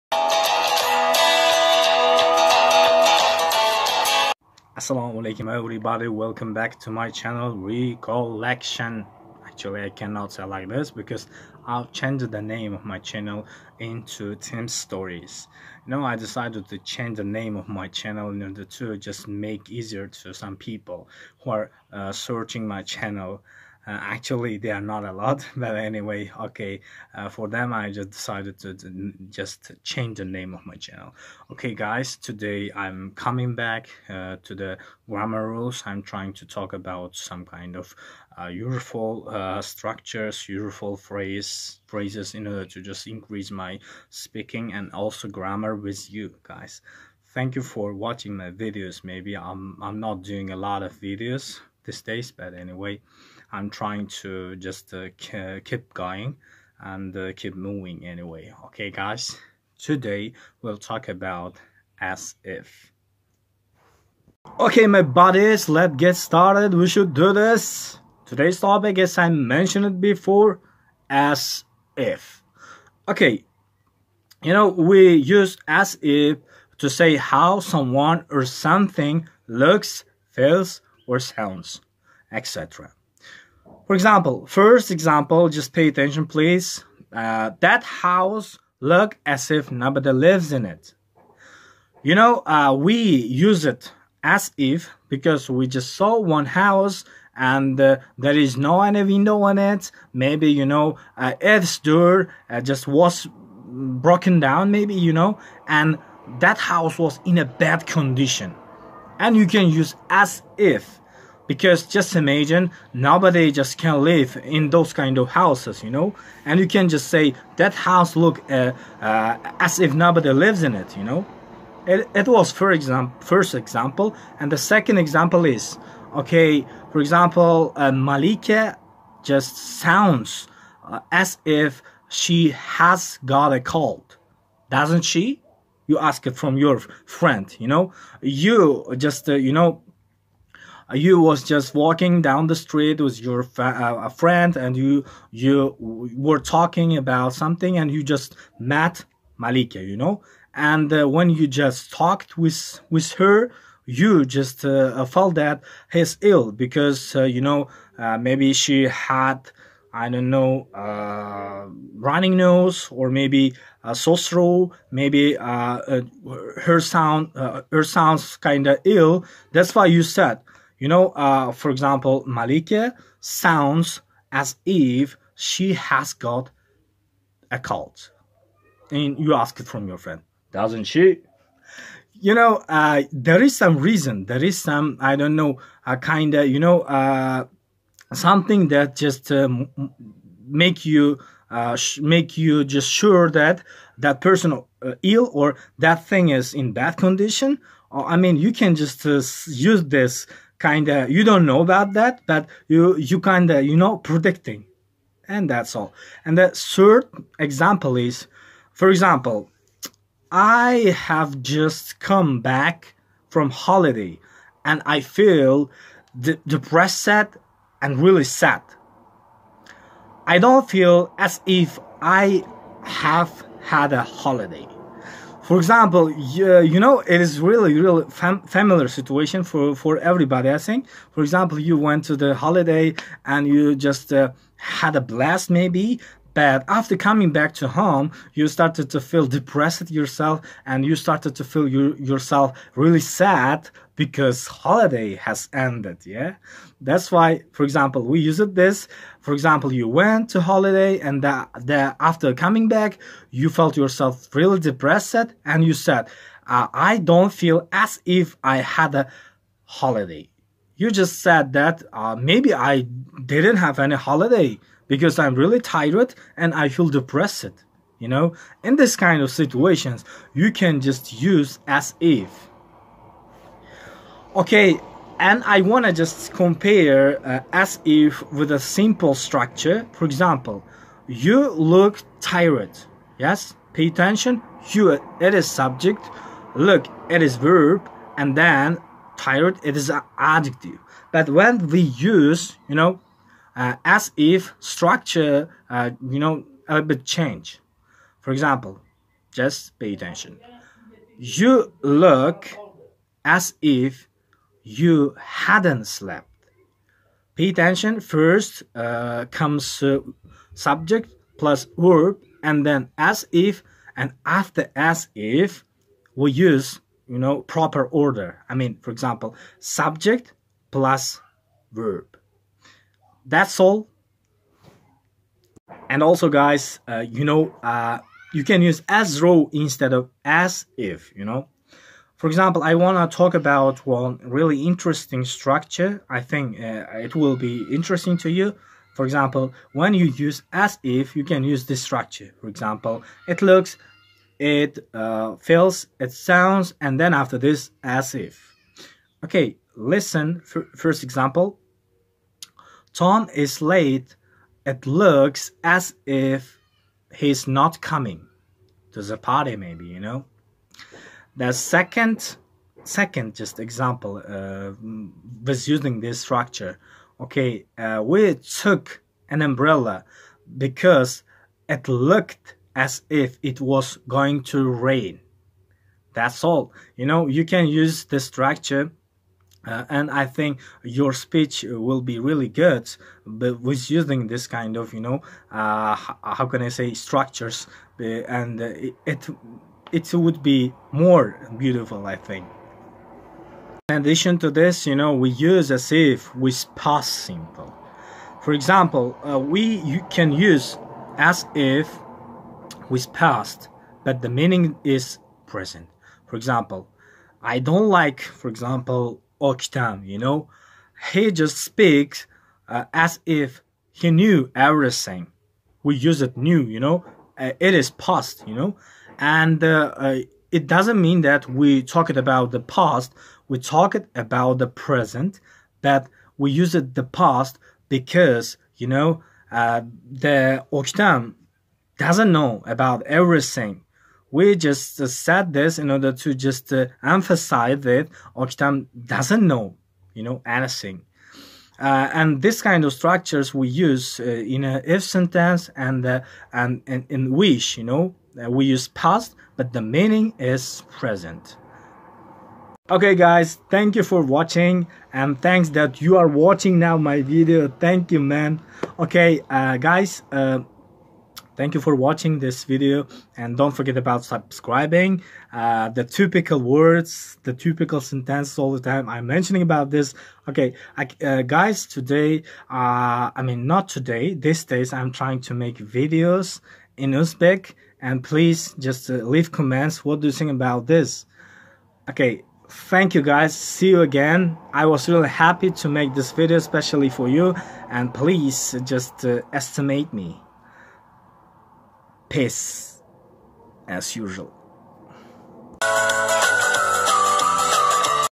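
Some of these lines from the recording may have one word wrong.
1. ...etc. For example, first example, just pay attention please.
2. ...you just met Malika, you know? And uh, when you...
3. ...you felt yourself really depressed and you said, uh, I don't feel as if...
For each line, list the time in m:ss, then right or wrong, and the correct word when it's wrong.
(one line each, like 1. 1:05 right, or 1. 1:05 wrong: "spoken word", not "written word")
1. 1:22 right
2. 2:27 right
3. 4:13 right.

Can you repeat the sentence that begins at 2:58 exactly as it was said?
And you ask it from your friend, doesn't she?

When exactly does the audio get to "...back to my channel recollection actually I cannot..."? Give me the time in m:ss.
0:06.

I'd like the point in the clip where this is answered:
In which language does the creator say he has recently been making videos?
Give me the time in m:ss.
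7:57.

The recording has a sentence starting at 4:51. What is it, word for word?
But when we use, you know, uh, as if structure, uh, you know, a bit change.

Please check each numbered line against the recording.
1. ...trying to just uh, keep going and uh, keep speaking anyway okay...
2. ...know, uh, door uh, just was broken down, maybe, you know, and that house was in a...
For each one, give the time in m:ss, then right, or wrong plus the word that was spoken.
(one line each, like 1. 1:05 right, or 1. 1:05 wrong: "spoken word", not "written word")
1. 0:53 wrong: "moving", not "speaking"
2. 1:40 right.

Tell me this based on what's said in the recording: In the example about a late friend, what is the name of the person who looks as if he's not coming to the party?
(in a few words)
Tom.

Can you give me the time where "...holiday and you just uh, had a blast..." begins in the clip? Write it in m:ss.
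3:52.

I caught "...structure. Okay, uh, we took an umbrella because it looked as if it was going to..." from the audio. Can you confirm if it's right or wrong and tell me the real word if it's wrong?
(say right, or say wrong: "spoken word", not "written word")
right.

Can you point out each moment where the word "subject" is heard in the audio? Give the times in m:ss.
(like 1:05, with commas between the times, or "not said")
4:45, 5:10, 5:19.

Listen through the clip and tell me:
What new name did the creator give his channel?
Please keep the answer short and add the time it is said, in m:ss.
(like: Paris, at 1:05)
Tim's Stories, at 0:14.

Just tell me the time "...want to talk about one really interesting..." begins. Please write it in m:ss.
5:32.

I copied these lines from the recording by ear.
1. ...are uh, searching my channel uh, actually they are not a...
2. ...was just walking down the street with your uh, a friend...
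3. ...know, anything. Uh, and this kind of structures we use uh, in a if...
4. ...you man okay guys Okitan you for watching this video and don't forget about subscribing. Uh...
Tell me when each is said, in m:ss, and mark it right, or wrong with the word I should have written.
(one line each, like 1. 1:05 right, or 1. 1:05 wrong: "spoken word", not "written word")
1. 0:21 right
2. 2:21 right
3. 7:20 right
4. 7:38 wrong: "Thank", not "Okitan".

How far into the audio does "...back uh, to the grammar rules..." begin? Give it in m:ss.
0:33.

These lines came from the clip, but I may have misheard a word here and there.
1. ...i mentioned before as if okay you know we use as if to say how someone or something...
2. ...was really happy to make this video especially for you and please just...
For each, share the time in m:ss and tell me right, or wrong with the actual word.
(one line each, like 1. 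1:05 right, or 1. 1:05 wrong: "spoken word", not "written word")
1. 1:09 right
2. 8:04 right.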